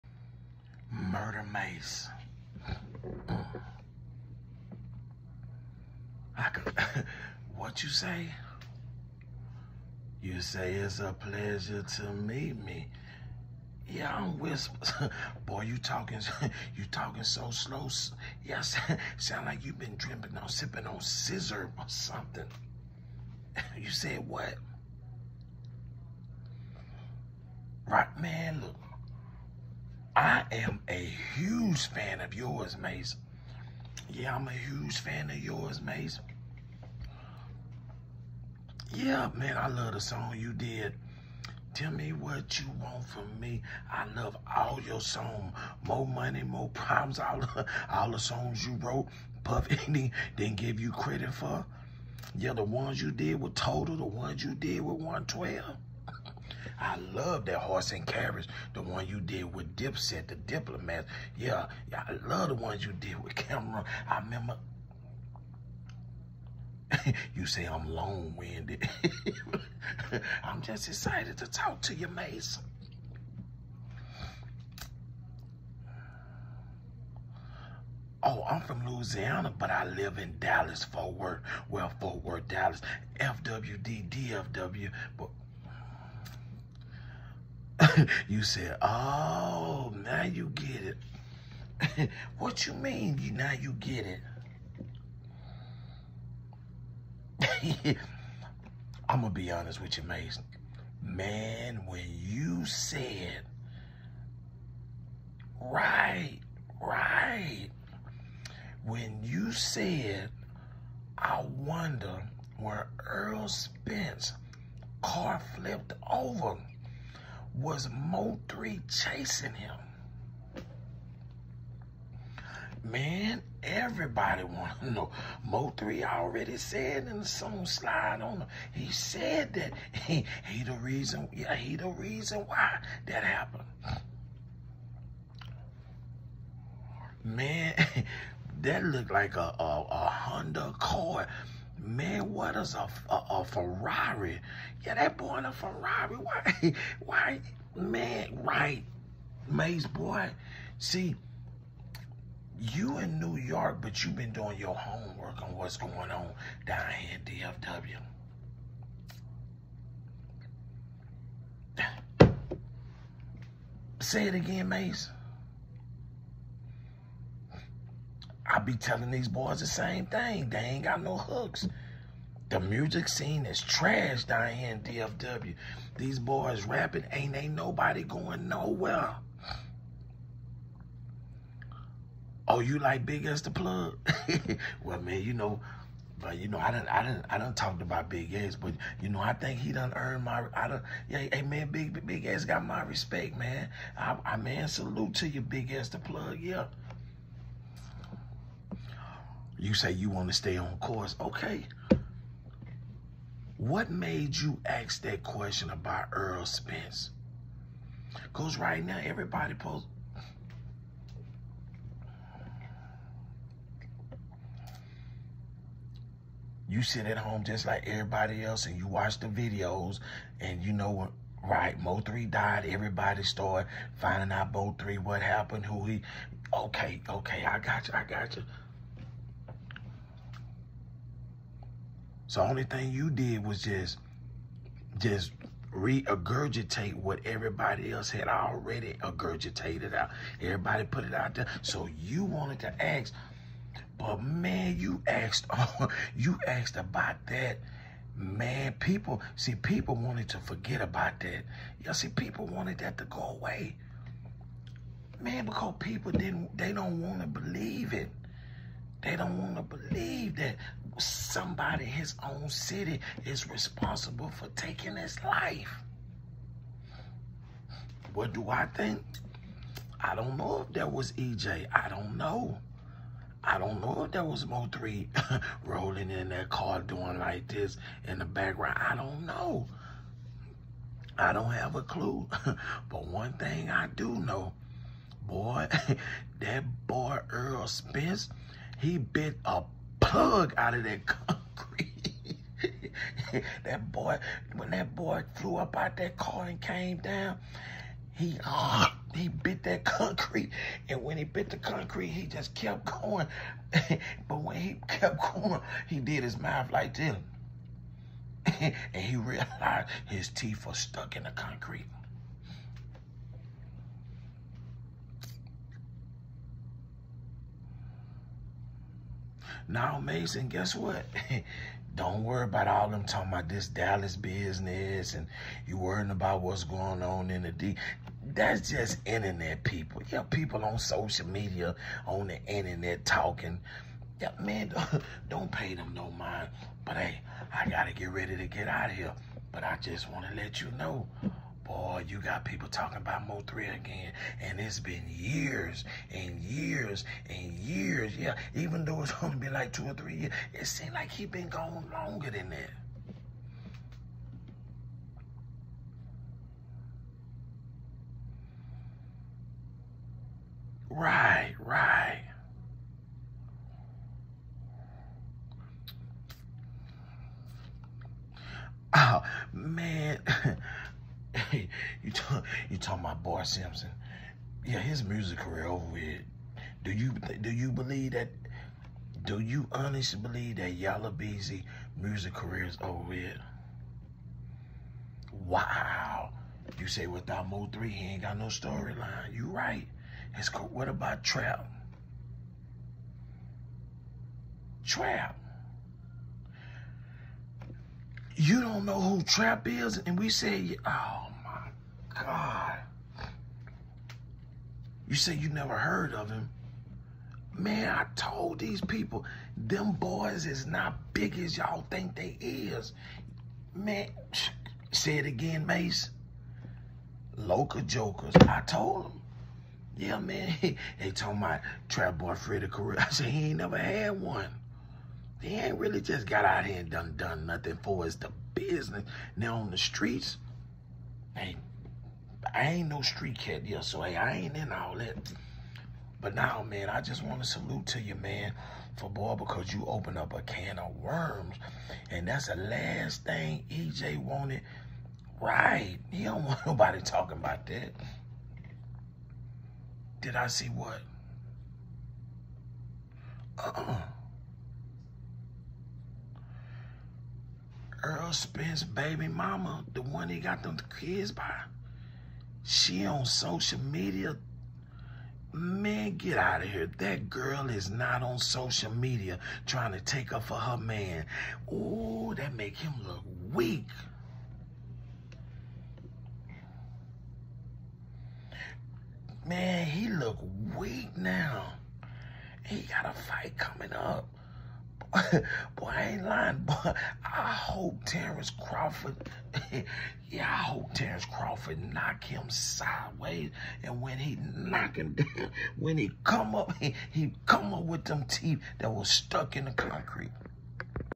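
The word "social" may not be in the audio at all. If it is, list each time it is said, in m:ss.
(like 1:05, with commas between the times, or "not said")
5:30, 7:43, 7:48.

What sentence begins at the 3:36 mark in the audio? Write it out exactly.
You sit at home just like everybody else and you watch the videos and you know what right?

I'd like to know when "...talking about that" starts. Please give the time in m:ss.
7:27.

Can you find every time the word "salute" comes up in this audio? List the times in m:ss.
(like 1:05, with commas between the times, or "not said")
3:14, 7:17.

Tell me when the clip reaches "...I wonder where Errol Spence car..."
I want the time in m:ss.
1:51.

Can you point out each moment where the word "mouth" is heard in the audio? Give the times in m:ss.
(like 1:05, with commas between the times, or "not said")
5:06.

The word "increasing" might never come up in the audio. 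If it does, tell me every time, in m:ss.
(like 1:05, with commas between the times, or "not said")
not said.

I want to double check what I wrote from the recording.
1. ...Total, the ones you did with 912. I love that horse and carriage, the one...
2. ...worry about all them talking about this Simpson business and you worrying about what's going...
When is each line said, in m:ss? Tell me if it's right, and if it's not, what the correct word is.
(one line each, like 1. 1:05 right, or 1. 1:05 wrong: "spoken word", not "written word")
1. 0:53 wrong: "112", not "912"
2. 5:22 wrong: "Dallas", not "Simpson".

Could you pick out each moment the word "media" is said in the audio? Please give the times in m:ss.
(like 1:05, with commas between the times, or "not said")
5:31, 7:43, 7:48.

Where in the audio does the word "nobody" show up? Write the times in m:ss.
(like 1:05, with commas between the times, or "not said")
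2:57, 7:26.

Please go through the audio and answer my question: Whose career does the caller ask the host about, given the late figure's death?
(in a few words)
Yella Beezy.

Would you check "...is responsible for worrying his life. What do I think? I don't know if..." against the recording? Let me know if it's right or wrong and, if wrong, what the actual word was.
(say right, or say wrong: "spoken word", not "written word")
wrong: "taking", not "worrying".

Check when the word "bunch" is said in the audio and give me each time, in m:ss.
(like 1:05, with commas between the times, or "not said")
not said.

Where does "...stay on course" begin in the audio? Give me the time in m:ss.
3:20.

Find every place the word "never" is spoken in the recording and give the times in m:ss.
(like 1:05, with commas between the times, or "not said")
6:45, 7:03.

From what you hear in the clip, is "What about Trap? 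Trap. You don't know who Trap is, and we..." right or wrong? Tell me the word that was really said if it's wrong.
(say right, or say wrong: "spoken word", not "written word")
right.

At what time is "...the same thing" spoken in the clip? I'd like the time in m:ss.
2:49.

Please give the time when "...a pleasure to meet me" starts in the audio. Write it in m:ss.
0:10.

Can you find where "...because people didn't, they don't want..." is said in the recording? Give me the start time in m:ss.
4:15.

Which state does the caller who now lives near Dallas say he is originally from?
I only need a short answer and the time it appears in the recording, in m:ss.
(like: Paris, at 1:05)
Louisiana, at 1:18.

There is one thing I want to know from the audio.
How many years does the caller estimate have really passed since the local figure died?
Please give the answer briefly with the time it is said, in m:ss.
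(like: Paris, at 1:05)
2 or 3, at 5:49.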